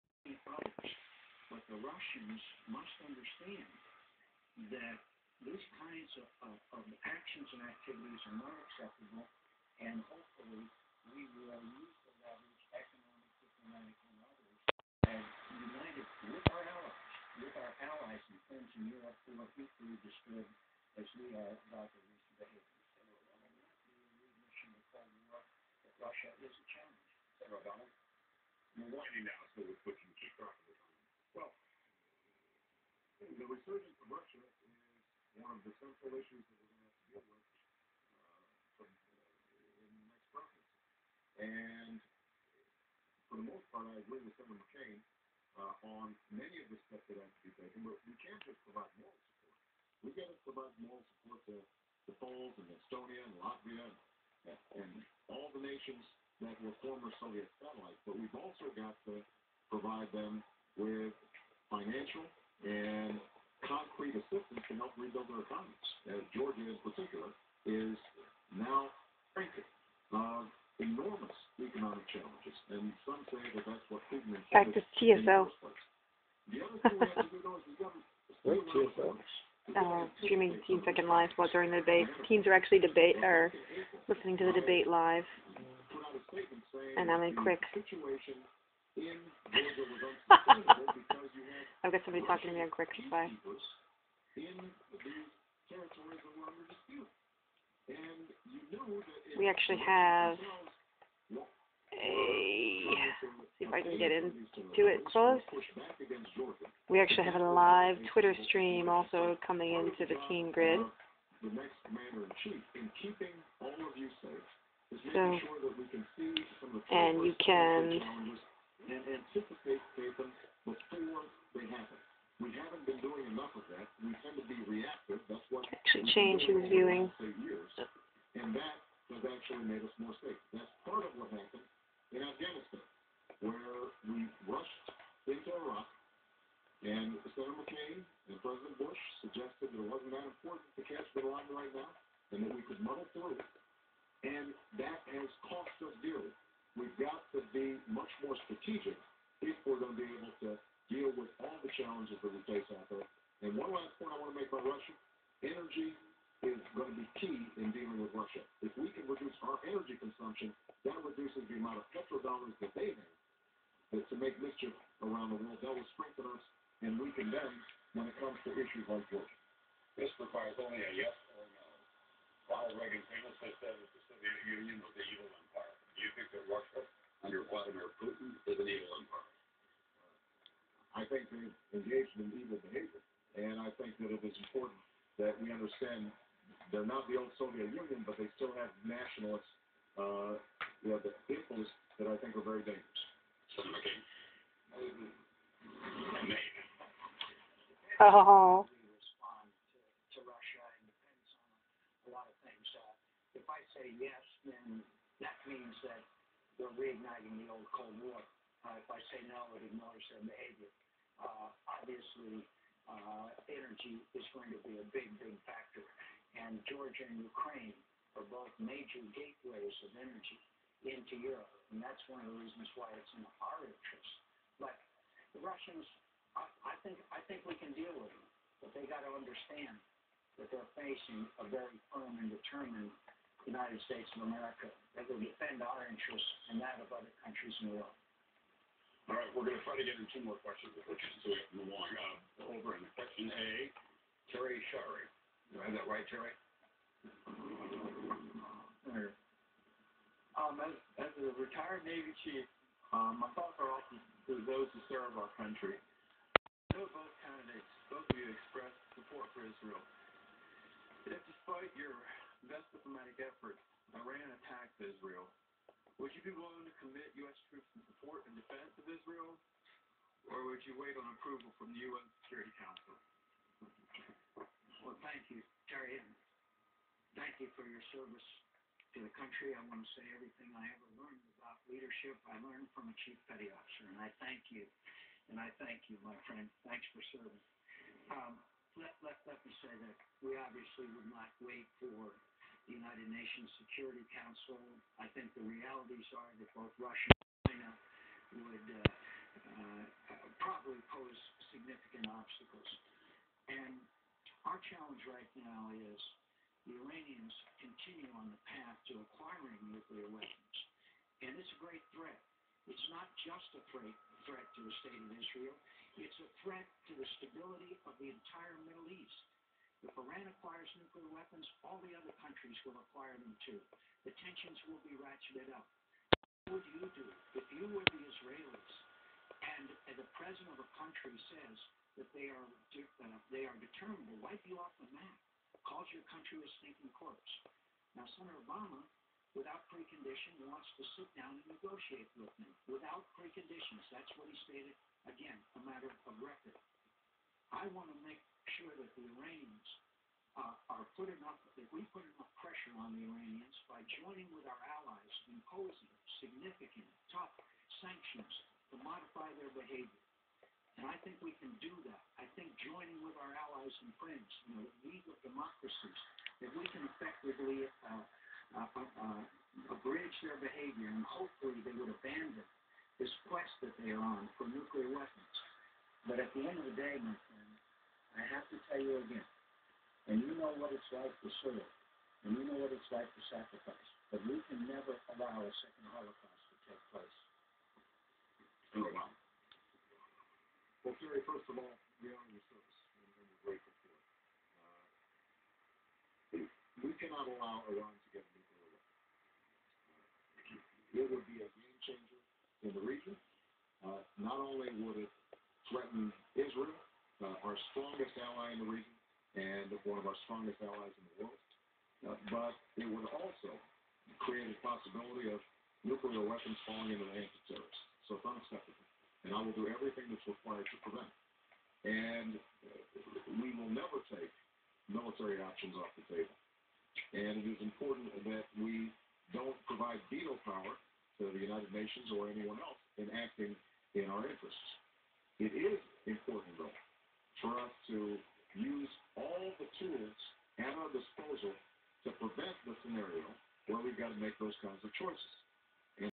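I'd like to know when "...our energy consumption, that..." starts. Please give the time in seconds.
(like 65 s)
159 s.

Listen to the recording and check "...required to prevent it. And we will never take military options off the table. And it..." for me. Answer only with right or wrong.
right.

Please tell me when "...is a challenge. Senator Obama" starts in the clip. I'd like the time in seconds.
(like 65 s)
26 s.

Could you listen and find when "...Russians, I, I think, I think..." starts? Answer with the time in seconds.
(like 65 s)
225 s.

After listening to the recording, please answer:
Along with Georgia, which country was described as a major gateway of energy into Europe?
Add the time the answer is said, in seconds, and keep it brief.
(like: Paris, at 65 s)
Ukraine, at 217 s.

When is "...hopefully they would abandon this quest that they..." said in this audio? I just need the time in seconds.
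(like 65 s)
371 s.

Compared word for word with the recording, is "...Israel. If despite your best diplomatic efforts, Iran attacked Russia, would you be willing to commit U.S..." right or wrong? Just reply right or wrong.
wrong.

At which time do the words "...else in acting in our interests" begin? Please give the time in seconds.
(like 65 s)
432 s.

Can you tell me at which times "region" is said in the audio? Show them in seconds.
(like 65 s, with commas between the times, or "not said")
402 s, 408 s.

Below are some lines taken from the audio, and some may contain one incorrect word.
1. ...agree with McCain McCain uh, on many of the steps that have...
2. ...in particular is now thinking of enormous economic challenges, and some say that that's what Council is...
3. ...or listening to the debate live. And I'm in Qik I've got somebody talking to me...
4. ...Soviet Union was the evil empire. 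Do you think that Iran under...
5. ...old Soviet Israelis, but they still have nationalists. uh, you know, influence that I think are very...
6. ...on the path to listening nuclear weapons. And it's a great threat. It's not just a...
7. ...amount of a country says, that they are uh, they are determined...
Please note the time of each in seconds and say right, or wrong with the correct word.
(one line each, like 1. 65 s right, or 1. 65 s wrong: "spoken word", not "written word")
1. 43 s wrong: "Senator", not "McCain"
2. 66 s wrong: "Putin", not "Council"
3. 83 s right
4. 174 s wrong: "Russia", not "Iran"
5. 187 s wrong: "Union", not "Israelis"
6. 308 s wrong: "acquiring", not "listening"
7. 330 s wrong: "president", not "amount".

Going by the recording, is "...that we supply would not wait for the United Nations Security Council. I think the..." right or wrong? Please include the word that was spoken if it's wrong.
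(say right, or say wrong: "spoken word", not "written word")
wrong: "obviously", not "supply".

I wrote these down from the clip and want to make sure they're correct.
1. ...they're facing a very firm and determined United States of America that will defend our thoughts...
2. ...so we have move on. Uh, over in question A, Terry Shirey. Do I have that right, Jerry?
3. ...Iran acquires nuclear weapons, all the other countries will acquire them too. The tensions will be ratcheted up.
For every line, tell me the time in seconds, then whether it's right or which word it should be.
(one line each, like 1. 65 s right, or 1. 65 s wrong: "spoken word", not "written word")
1. 230 s wrong: "interests", not "thoughts"
2. 240 s right
3. 319 s right.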